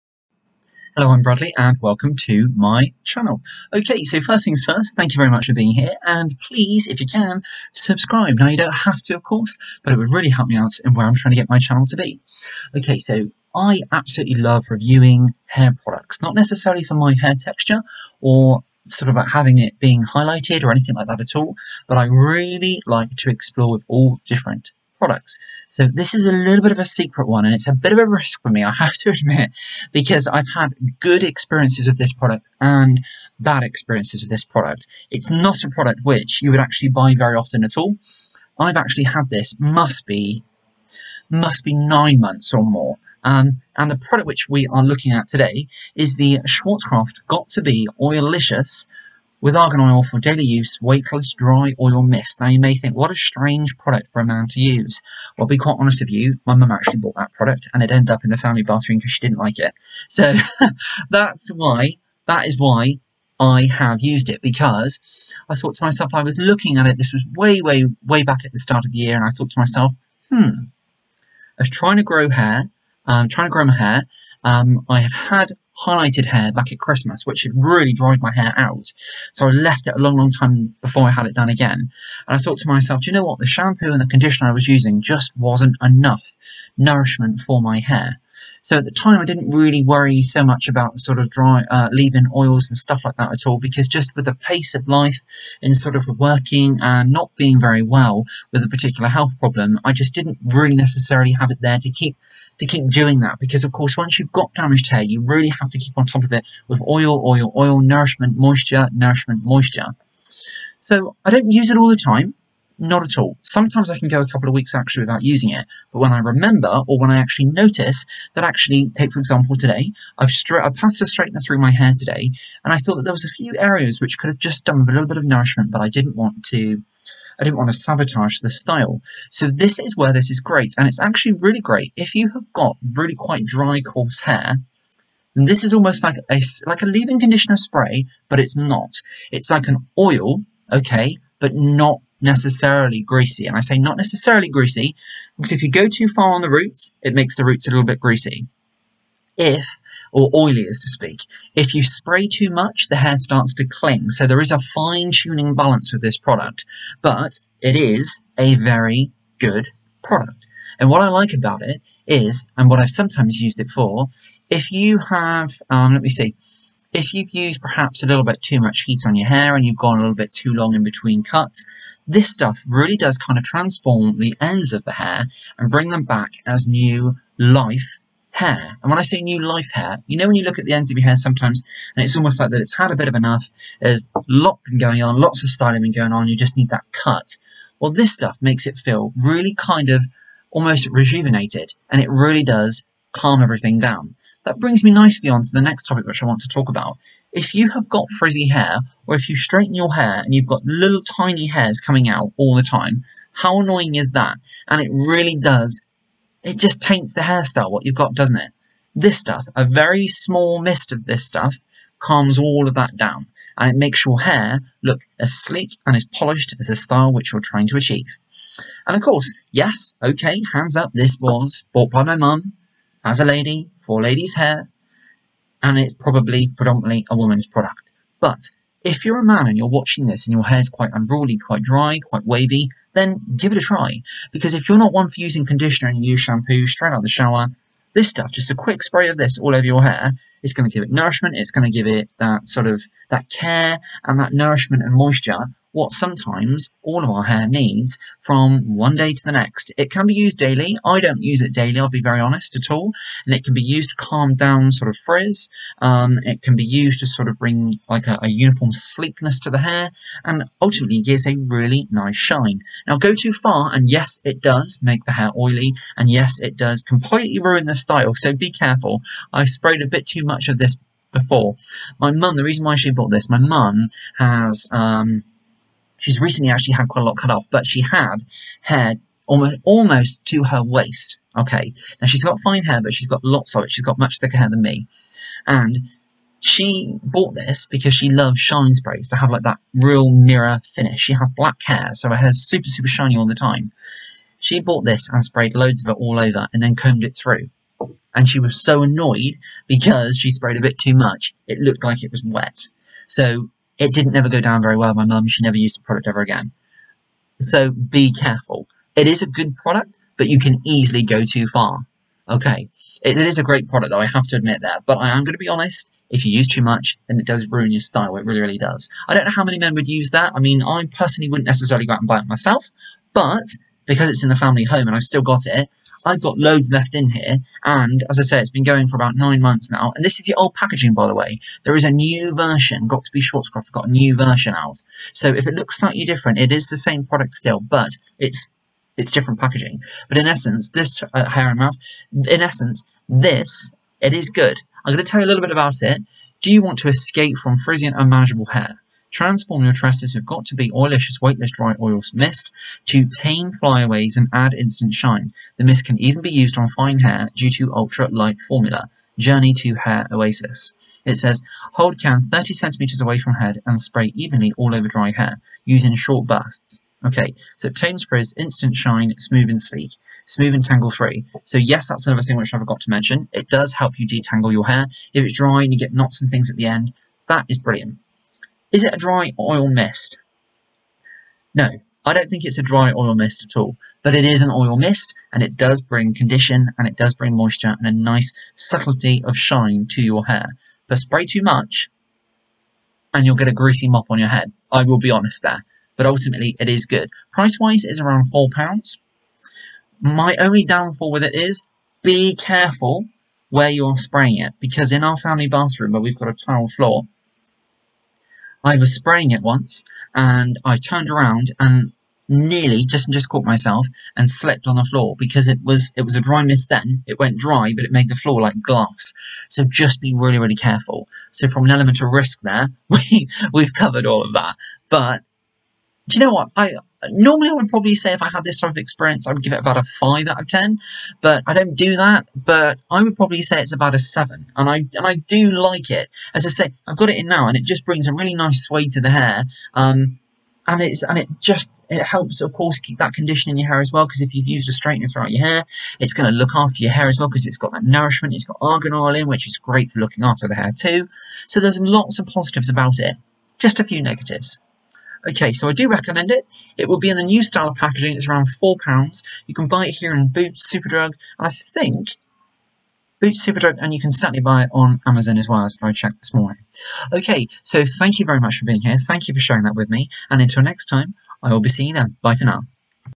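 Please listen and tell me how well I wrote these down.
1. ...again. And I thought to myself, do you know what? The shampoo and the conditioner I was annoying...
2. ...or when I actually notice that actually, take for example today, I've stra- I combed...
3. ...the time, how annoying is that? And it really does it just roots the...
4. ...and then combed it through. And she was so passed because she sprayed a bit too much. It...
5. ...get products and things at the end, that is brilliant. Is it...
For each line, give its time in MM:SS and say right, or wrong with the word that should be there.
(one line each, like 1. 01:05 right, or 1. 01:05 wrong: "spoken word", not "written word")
1. 01:21 wrong: "using", not "annoying"
2. 01:56 wrong: "passed", not "combed"
3. 03:22 wrong: "taints", not "roots"
4. 04:56 wrong: "annoyed", not "passed"
5. 06:15 wrong: "knots", not "products".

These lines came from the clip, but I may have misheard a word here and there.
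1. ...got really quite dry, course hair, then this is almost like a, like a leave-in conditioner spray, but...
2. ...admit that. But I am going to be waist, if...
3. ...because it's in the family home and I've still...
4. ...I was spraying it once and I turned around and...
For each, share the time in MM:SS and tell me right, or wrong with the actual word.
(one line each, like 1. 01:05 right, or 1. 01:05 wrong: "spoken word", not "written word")
1. 02:12 wrong: "coarse", not "course"
2. 05:14 wrong: "honest", not "waist"
3. 05:23 right
4. 06:48 right.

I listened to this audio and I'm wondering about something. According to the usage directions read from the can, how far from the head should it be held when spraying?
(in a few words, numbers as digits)
30 centimeters.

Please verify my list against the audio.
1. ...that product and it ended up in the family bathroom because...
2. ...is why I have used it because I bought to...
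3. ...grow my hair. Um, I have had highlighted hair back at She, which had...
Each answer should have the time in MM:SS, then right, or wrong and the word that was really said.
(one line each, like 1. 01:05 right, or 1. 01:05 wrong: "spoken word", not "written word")
1. 00:57 right
2. 01:02 wrong: "thought", not "bought"
3. 01:13 wrong: "Christmas", not "She".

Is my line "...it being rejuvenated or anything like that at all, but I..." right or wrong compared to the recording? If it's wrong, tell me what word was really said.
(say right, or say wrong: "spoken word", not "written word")
wrong: "highlighted", not "rejuvenated".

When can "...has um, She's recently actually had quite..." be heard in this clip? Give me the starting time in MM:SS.
04:34.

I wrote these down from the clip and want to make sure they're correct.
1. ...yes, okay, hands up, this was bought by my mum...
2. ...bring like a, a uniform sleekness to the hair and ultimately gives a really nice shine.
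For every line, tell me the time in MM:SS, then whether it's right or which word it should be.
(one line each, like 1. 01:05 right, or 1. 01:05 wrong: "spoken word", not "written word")
1. 03:39 right
2. 04:17 right.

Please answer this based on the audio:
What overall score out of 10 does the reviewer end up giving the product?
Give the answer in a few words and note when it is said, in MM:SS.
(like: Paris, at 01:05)
7, at 07:13.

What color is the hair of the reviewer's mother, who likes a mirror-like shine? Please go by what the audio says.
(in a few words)
black.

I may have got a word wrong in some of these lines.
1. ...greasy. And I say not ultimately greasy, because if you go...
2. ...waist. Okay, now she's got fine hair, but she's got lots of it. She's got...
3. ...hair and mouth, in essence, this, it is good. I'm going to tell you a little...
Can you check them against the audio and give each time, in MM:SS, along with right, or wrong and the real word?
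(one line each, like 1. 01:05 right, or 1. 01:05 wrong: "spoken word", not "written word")
1. 02:23 wrong: "necessarily", not "ultimately"
2. 04:40 right
3. 05:41 right.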